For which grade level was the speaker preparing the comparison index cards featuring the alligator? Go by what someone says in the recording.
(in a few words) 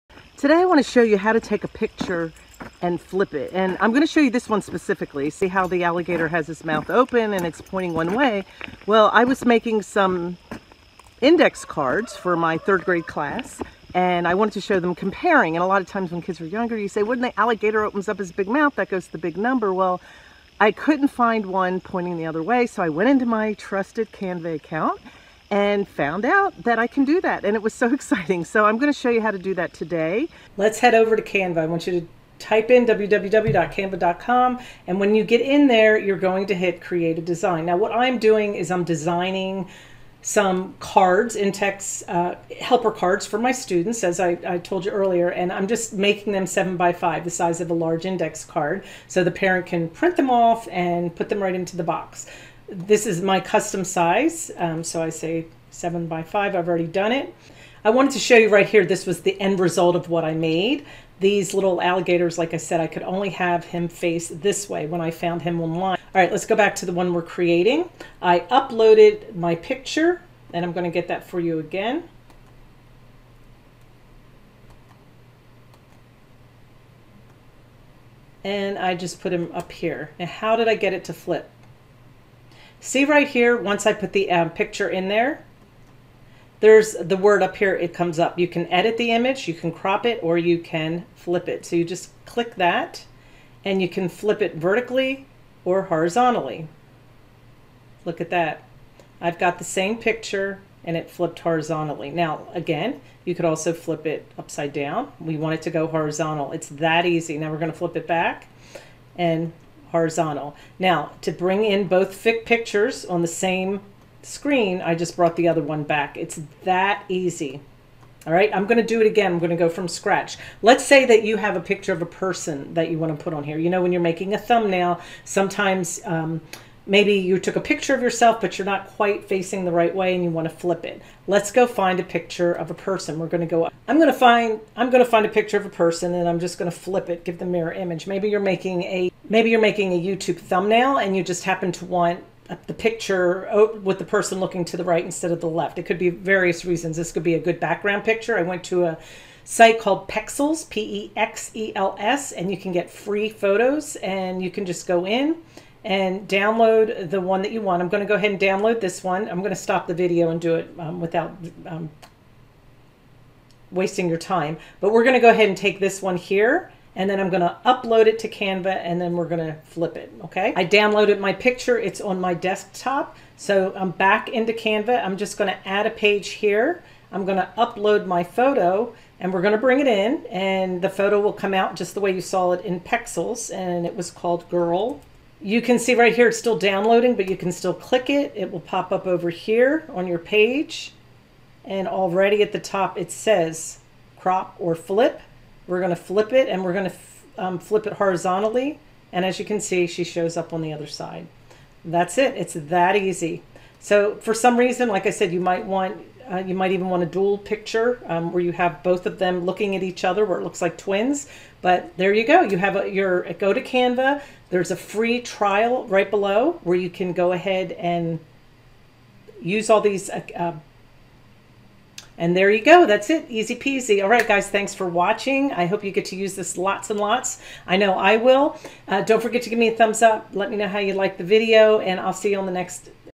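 Third grade.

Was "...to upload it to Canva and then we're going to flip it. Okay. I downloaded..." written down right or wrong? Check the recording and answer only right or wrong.
right.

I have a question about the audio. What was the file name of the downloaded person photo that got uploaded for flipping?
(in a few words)
girl.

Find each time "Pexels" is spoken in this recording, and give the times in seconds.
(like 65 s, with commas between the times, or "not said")
150 s, 182 s.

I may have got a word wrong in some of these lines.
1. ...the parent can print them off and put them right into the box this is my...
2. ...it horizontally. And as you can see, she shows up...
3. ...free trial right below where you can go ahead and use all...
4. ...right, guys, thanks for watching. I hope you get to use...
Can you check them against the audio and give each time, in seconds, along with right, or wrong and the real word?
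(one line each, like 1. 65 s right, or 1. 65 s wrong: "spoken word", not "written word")
1. 49 s right
2. 197 s right
3. 214 s right
4. 224 s right.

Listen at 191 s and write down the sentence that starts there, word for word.
And already at the top, it says crop or flip.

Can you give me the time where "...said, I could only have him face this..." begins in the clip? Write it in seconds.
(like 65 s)
62 s.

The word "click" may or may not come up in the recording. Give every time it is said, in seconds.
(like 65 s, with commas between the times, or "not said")
92 s, 187 s.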